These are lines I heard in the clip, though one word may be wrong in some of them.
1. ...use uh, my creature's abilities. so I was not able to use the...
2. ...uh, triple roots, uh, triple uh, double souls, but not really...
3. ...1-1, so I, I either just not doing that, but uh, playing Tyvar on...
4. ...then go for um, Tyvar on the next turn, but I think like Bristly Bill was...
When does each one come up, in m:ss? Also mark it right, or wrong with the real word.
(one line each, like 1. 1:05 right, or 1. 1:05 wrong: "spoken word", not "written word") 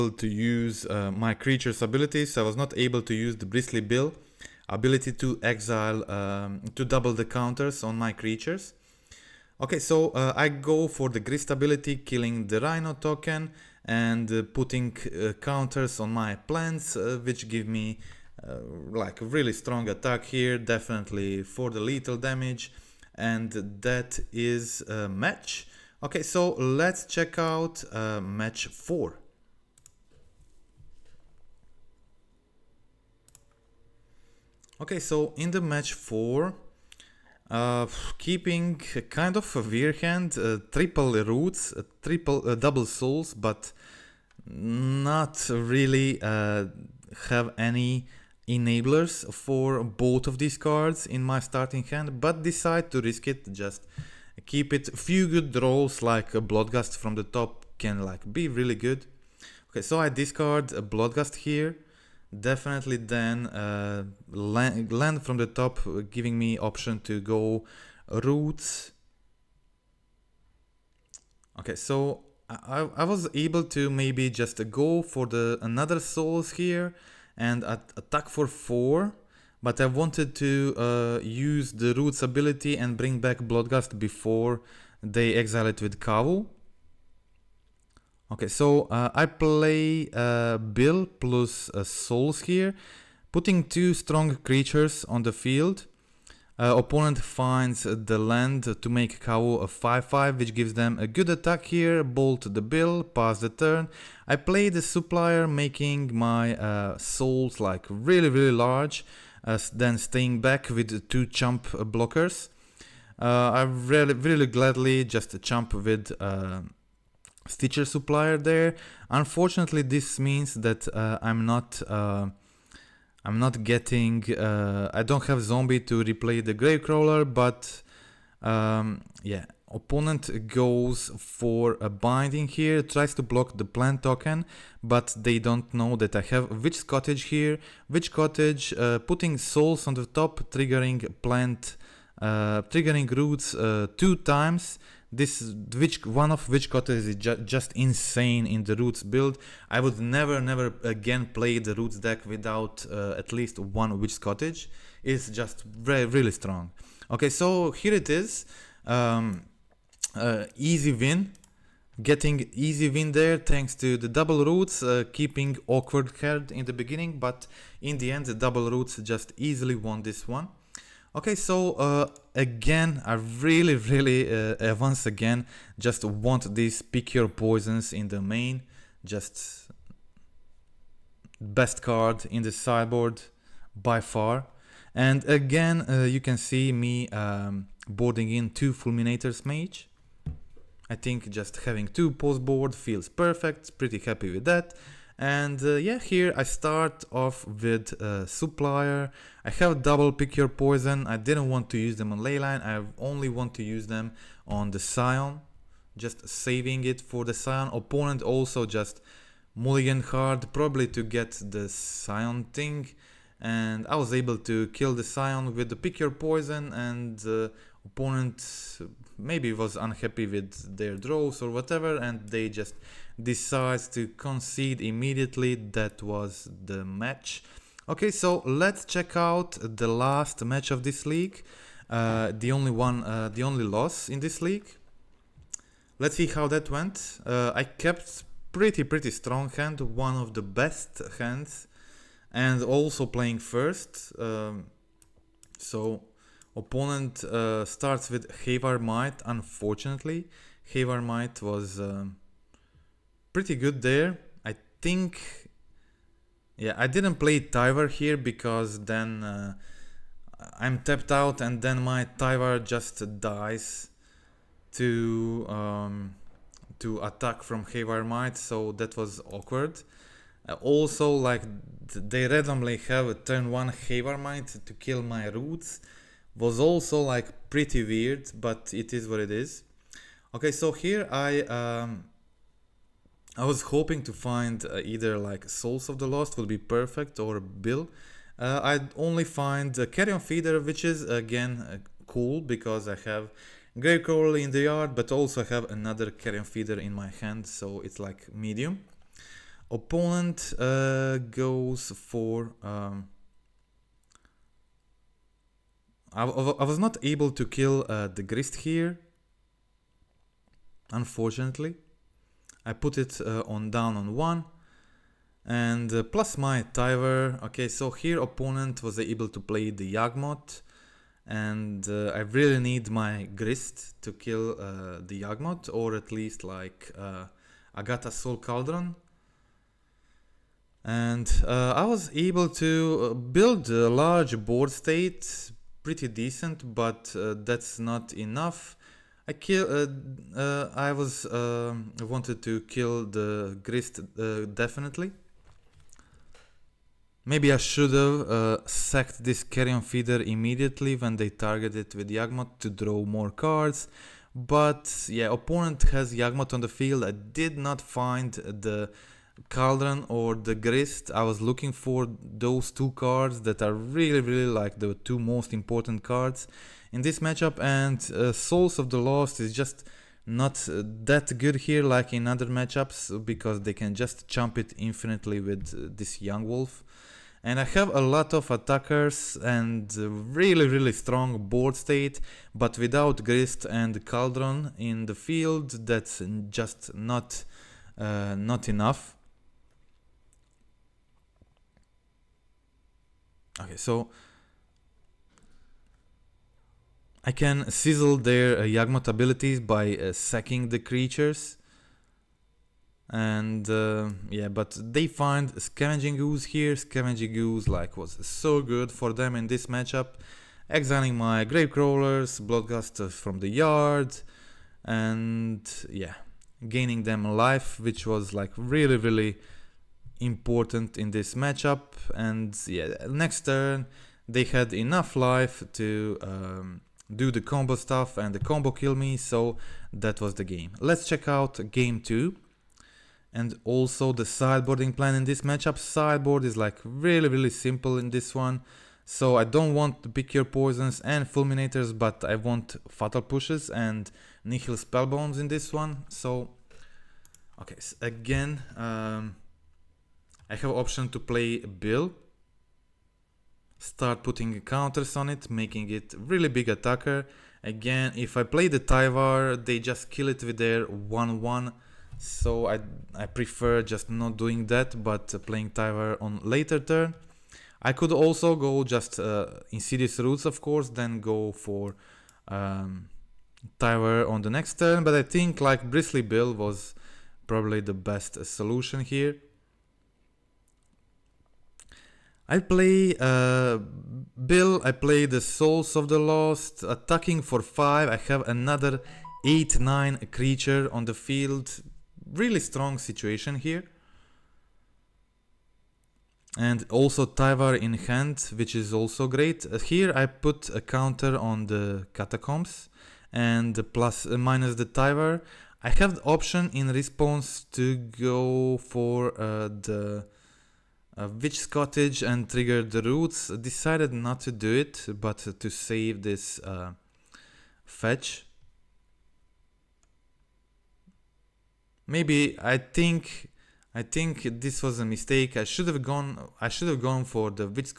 1. 0:00 right
2. 0:40 right
3. 7:40 wrong: "prefer", not "either"
4. 7:50 right.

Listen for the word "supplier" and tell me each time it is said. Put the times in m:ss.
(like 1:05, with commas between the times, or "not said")
1:44, 1:57, 3:18.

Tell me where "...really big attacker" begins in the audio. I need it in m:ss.
7:36.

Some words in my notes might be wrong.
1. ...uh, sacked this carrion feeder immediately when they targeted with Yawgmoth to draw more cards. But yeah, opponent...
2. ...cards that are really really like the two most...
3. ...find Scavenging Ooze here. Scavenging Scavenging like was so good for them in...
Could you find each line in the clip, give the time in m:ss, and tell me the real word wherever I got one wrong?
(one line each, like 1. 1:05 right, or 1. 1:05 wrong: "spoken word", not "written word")
1. 5:48 right
2. 6:02 right
3. 6:45 wrong: "Ooze", not "Scavenging".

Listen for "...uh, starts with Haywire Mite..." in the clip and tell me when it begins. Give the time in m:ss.
4:07.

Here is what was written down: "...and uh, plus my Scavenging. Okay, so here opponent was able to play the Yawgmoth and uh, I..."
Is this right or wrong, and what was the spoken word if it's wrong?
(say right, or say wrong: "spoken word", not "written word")
wrong: "Tyvar", not "Scavenging".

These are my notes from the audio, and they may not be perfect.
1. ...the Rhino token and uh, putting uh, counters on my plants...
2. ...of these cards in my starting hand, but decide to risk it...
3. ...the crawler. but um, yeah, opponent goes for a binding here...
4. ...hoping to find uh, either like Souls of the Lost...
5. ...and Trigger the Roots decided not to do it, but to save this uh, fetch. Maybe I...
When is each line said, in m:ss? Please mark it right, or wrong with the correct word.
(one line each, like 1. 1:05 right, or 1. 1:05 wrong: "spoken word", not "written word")
1. 0:12 right
2. 0:50 right
3. 2:06 right
4. 4:43 right
5. 8:32 right.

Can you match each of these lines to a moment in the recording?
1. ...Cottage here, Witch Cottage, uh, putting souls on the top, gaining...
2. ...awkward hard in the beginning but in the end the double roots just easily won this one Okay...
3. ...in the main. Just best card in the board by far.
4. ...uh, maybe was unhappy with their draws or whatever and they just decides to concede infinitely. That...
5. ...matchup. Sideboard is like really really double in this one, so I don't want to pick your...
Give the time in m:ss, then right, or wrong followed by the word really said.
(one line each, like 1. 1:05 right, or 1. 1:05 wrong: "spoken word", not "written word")
1. 2:16 wrong: "triggering", not "gaining"
2. 2:45 right
3. 2:57 wrong: "sideboard", not "board"
4. 3:38 wrong: "immediately", not "infinitely"
5. 7:15 wrong: "simple", not "double".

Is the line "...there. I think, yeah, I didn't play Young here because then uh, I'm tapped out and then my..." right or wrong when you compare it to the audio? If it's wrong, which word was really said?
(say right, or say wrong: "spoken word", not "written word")
wrong: "Tyvar", not "Young".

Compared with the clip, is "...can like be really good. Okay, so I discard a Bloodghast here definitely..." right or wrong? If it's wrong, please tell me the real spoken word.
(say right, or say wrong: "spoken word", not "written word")
right.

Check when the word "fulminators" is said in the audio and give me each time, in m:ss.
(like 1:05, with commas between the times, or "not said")
3:08, 7:21.